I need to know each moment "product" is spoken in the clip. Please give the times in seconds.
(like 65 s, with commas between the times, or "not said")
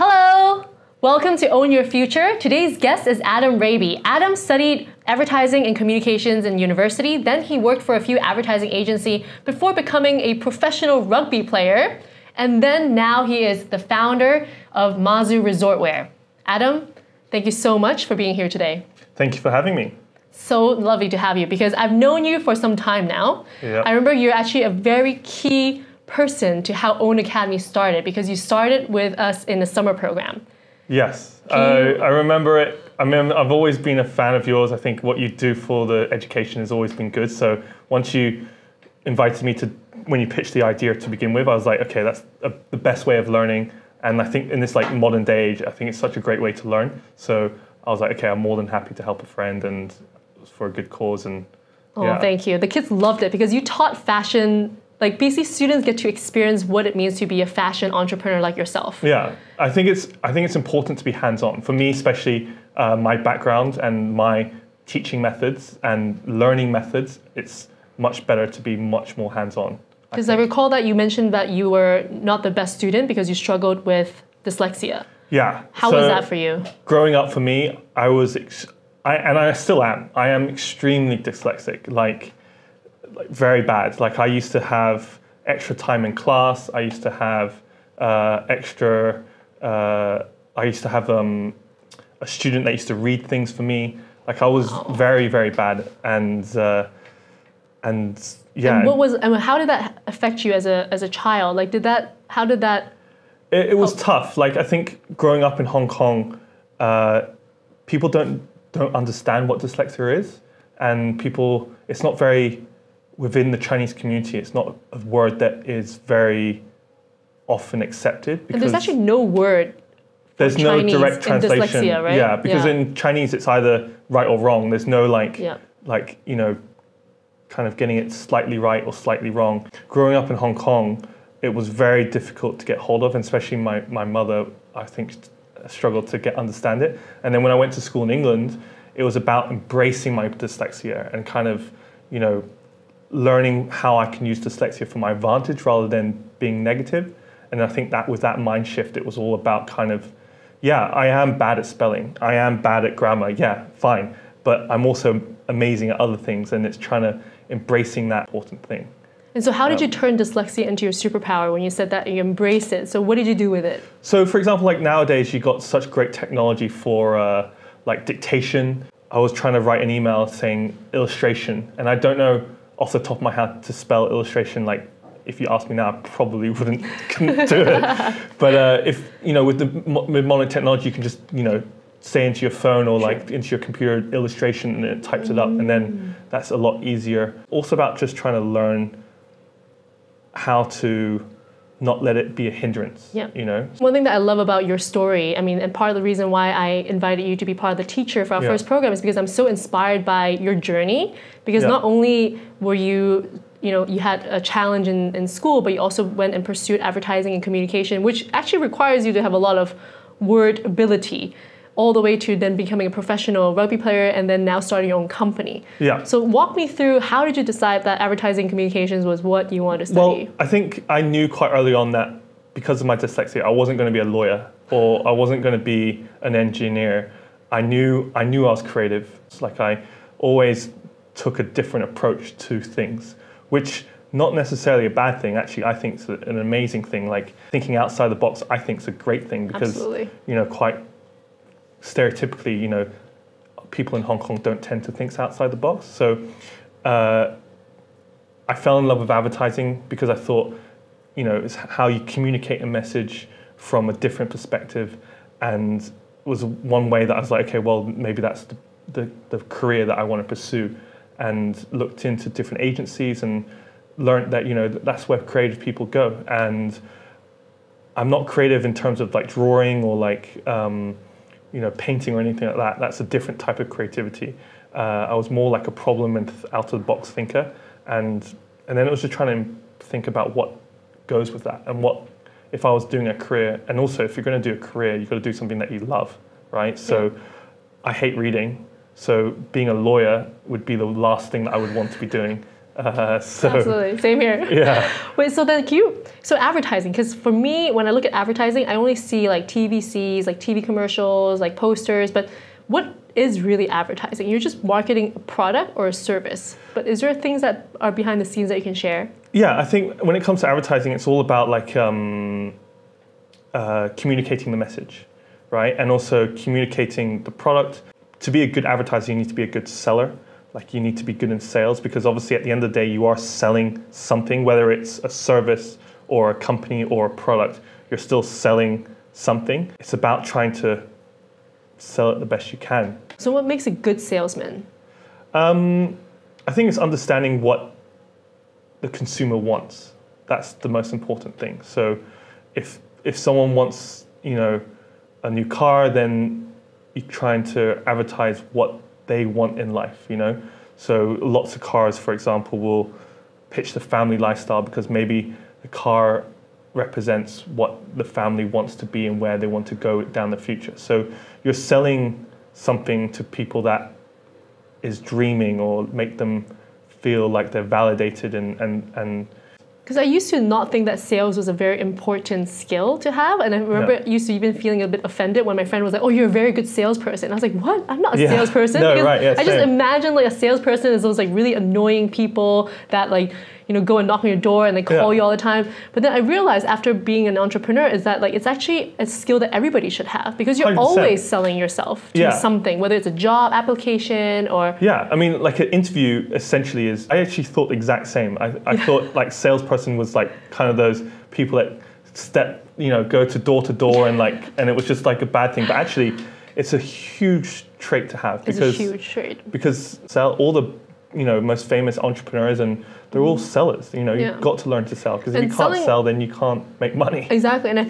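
305 s, 317 s, 327 s.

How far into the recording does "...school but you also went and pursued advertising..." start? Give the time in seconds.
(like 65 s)
205 s.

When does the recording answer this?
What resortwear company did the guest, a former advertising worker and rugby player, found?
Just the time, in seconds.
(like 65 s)
14 s.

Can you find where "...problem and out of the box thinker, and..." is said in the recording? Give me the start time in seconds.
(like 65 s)
275 s.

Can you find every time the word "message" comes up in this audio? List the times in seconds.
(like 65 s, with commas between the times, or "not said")
252 s, 314 s.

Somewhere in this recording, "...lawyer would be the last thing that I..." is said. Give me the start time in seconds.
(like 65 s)
289 s.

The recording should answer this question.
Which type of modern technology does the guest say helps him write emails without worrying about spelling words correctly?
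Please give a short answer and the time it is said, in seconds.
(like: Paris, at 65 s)
dictation, at 168 s.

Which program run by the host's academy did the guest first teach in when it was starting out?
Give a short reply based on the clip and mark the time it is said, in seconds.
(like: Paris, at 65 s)
summer program, at 29 s.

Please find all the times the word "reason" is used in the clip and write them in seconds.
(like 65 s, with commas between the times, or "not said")
196 s.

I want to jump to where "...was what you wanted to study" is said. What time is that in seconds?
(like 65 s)
219 s.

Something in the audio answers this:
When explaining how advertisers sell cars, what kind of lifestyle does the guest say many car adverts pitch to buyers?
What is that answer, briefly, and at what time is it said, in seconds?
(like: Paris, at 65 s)
family lifestyle, at 353 s.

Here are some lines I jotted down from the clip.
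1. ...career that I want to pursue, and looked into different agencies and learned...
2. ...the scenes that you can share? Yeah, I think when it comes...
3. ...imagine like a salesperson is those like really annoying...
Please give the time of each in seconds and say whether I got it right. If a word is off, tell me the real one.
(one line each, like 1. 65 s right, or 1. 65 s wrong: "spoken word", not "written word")
1. 259 s right
2. 308 s right
3. 379 s right.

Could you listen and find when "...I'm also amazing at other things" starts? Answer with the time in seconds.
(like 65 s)
154 s.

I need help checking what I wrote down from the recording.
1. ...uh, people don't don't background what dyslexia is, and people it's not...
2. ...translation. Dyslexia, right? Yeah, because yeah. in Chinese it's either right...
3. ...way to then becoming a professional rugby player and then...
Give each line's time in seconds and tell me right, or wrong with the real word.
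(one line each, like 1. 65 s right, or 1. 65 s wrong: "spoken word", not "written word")
1. 106 s wrong: "understand", not "background"
2. 121 s right
3. 212 s right.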